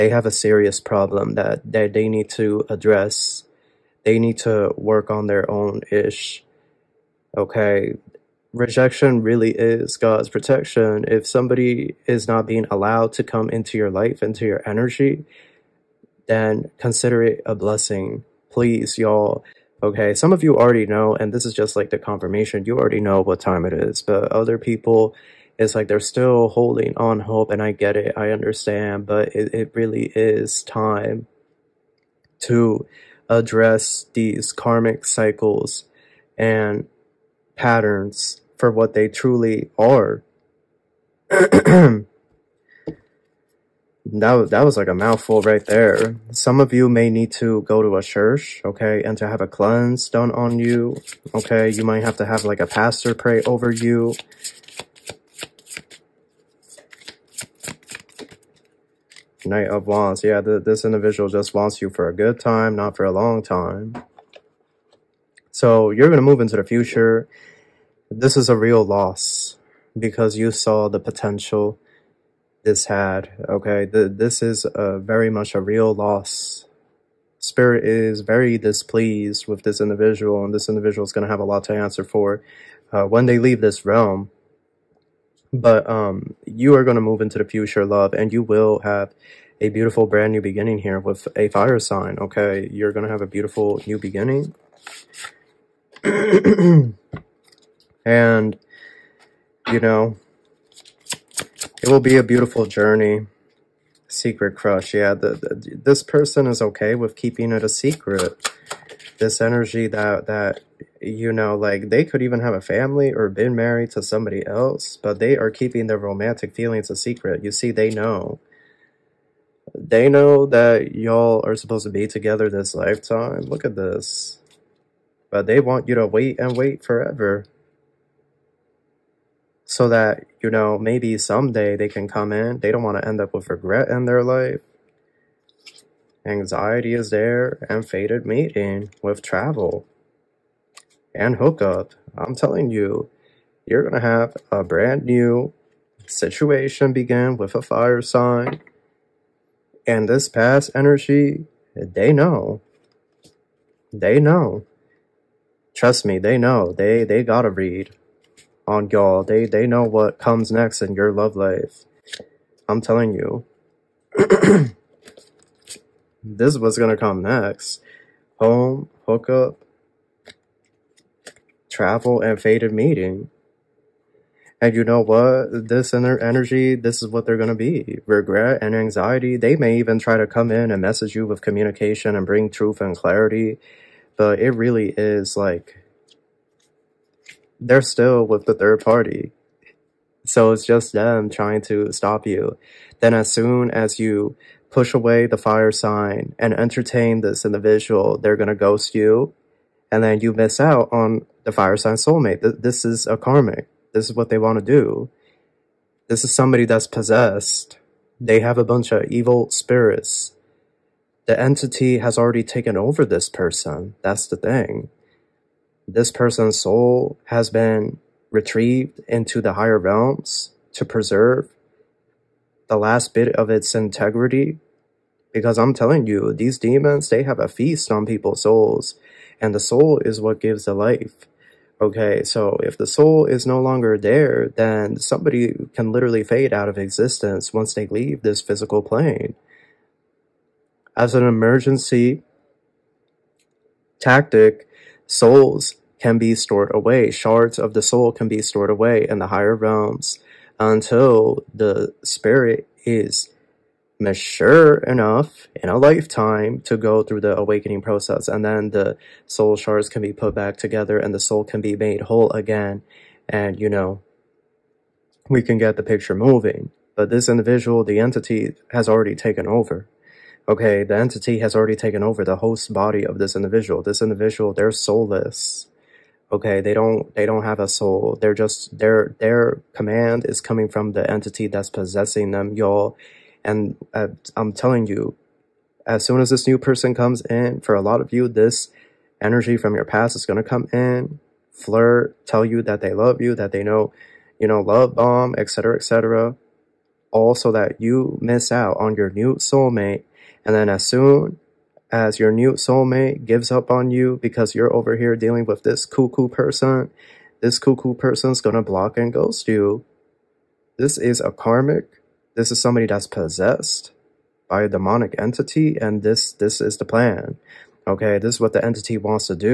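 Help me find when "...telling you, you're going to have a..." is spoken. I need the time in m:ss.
2:22.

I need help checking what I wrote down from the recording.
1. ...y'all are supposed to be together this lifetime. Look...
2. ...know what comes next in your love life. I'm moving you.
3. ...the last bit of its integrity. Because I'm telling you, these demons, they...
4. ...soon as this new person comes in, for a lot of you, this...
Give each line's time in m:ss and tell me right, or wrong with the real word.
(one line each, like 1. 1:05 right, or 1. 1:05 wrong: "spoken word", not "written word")
1. 2:00 right
2. 2:39 wrong: "telling", not "moving"
3. 3:42 right
4. 4:46 right.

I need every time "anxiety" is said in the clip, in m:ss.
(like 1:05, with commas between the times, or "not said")
2:16, 2:58.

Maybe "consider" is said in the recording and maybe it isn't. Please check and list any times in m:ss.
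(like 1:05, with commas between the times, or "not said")
0:16.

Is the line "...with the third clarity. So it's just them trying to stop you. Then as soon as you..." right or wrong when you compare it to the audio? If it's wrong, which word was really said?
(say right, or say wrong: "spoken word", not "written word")
wrong: "party", not "clarity".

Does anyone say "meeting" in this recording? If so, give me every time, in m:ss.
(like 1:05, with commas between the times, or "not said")
2:18, 2:52.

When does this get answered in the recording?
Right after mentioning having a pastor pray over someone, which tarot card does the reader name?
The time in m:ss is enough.
0:59.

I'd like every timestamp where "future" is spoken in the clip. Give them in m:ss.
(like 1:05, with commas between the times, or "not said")
1:06, 1:27.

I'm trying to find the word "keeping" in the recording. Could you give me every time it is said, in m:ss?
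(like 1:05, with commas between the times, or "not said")
1:47, 1:55.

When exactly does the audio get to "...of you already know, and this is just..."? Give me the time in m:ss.
0:20.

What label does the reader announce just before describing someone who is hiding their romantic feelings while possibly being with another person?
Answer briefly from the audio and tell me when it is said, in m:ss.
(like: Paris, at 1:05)
Secret crush, at 1:44.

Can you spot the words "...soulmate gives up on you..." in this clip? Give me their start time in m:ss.
5:02.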